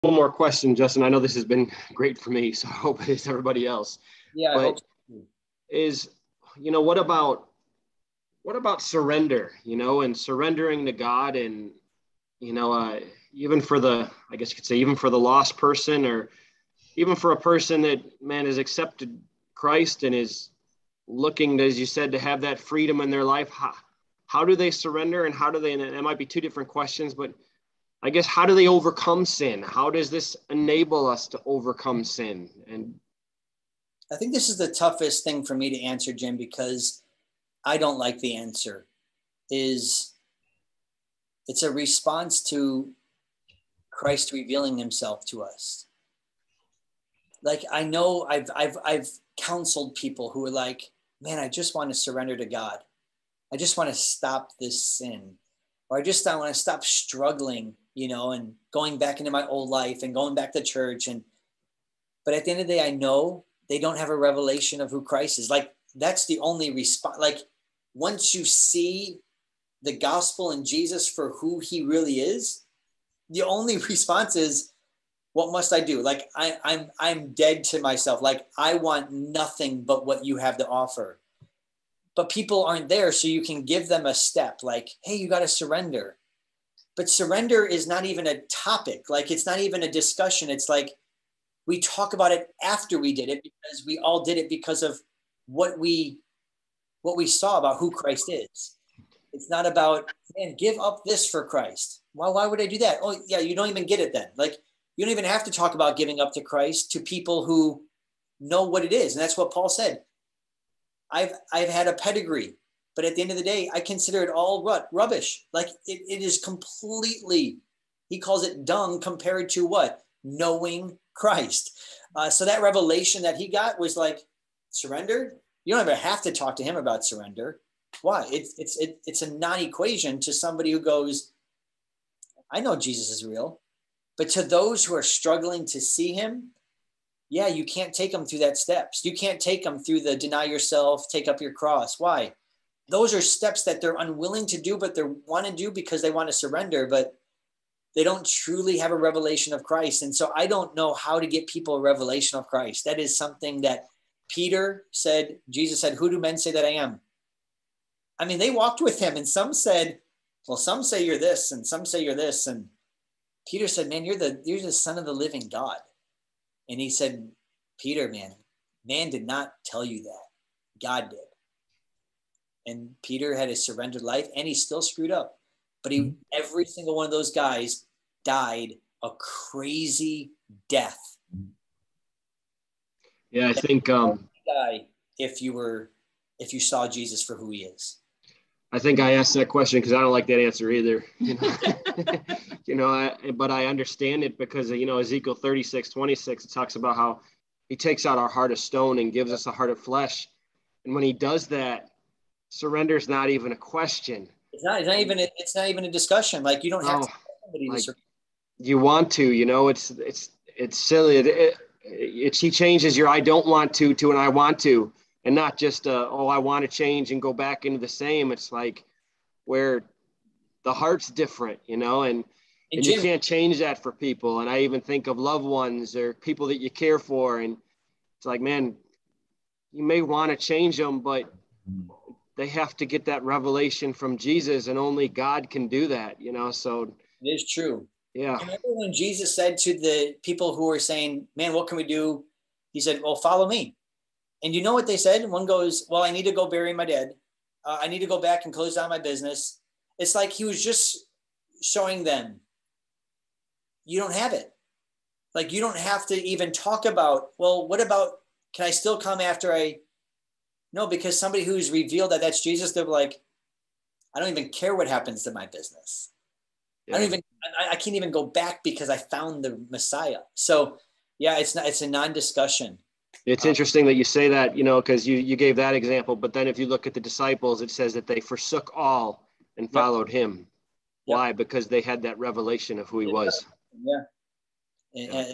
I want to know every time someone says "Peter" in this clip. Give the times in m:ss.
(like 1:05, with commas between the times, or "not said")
2:34, 2:43, 2:47, 2:53.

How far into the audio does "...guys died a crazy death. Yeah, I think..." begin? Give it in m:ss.
2:57.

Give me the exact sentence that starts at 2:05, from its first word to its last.
You don't ever have to talk to him about surrender.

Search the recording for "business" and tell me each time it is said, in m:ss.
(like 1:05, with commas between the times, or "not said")
4:08, 4:25.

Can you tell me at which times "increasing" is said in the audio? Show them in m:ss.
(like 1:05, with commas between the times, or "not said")
not said.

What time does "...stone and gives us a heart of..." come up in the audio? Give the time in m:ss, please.
3:18.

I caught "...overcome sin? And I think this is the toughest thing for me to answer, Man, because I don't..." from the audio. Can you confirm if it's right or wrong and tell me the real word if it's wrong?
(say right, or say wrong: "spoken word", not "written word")
wrong: "Jim", not "Man".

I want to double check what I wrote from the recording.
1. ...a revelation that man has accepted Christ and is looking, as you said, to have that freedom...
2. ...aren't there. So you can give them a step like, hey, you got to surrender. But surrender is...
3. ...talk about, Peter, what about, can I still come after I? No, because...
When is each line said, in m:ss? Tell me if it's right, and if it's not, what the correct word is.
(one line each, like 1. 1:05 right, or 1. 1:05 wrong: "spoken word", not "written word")
1. 0:17 wrong: "person", not "revelation"
2. 1:22 right
3. 4:16 wrong: "Well", not "Peter".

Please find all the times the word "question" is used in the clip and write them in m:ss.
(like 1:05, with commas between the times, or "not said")
0:00, 0:26, 3:09, 3:23.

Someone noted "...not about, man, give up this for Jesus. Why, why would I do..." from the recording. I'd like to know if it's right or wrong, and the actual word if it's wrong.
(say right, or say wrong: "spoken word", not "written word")
wrong: "Christ", not "Jesus".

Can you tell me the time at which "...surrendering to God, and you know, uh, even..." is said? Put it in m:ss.
0:10.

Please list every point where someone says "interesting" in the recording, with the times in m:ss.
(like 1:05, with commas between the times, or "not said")
4:33.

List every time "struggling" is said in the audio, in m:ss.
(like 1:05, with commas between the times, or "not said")
0:56, 2:15.